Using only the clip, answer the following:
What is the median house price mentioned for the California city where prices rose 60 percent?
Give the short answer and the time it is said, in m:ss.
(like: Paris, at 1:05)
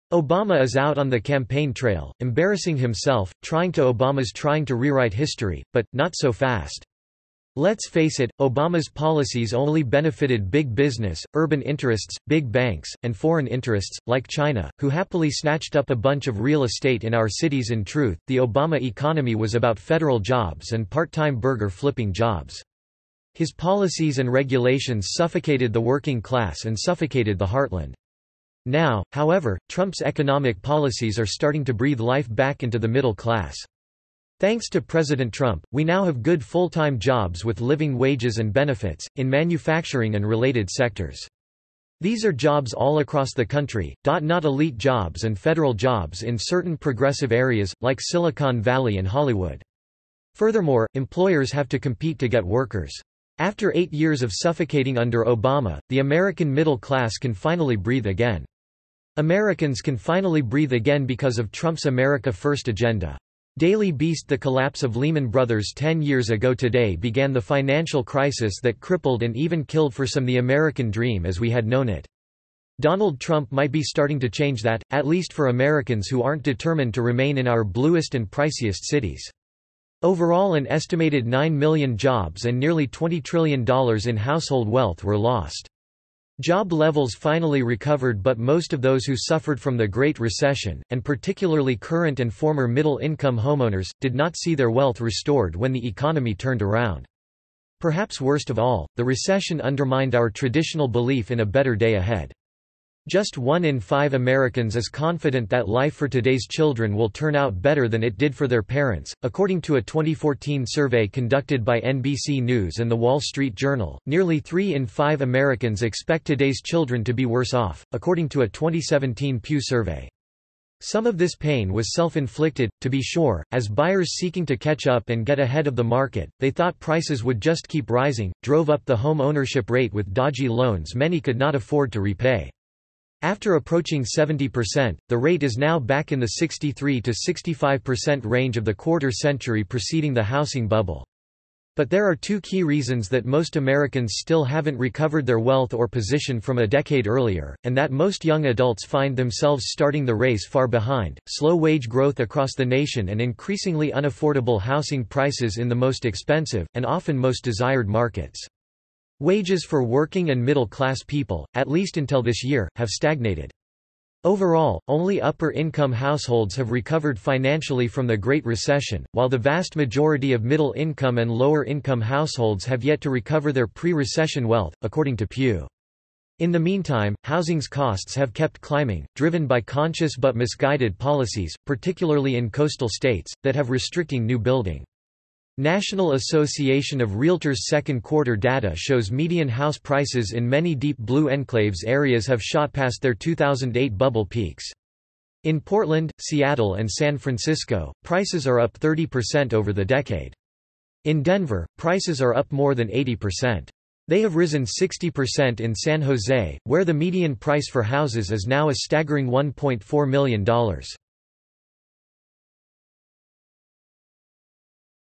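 $1.4 million, at 3:29.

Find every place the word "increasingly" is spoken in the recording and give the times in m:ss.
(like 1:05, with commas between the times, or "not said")
2:33.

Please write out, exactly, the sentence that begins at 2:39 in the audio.
Wages for working and middle-class people, at least until this year, have stagnated.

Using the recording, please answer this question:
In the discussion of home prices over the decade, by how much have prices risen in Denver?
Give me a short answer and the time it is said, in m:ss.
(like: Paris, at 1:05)
more than 80%, at 3:22.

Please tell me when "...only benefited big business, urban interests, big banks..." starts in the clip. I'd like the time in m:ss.
0:09.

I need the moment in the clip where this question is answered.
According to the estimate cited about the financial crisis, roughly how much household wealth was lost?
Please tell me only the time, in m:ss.
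1:22.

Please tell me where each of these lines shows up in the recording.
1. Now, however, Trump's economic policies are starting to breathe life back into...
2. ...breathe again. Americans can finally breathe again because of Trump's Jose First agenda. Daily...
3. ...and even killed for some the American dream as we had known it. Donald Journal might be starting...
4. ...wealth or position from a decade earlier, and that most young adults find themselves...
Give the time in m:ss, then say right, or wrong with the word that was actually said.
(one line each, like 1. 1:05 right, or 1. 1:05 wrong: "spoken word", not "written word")
1. 0:28 right
2. 0:57 wrong: "America", not "Jose"
3. 1:09 wrong: "Trump", not "Journal"
4. 2:25 right.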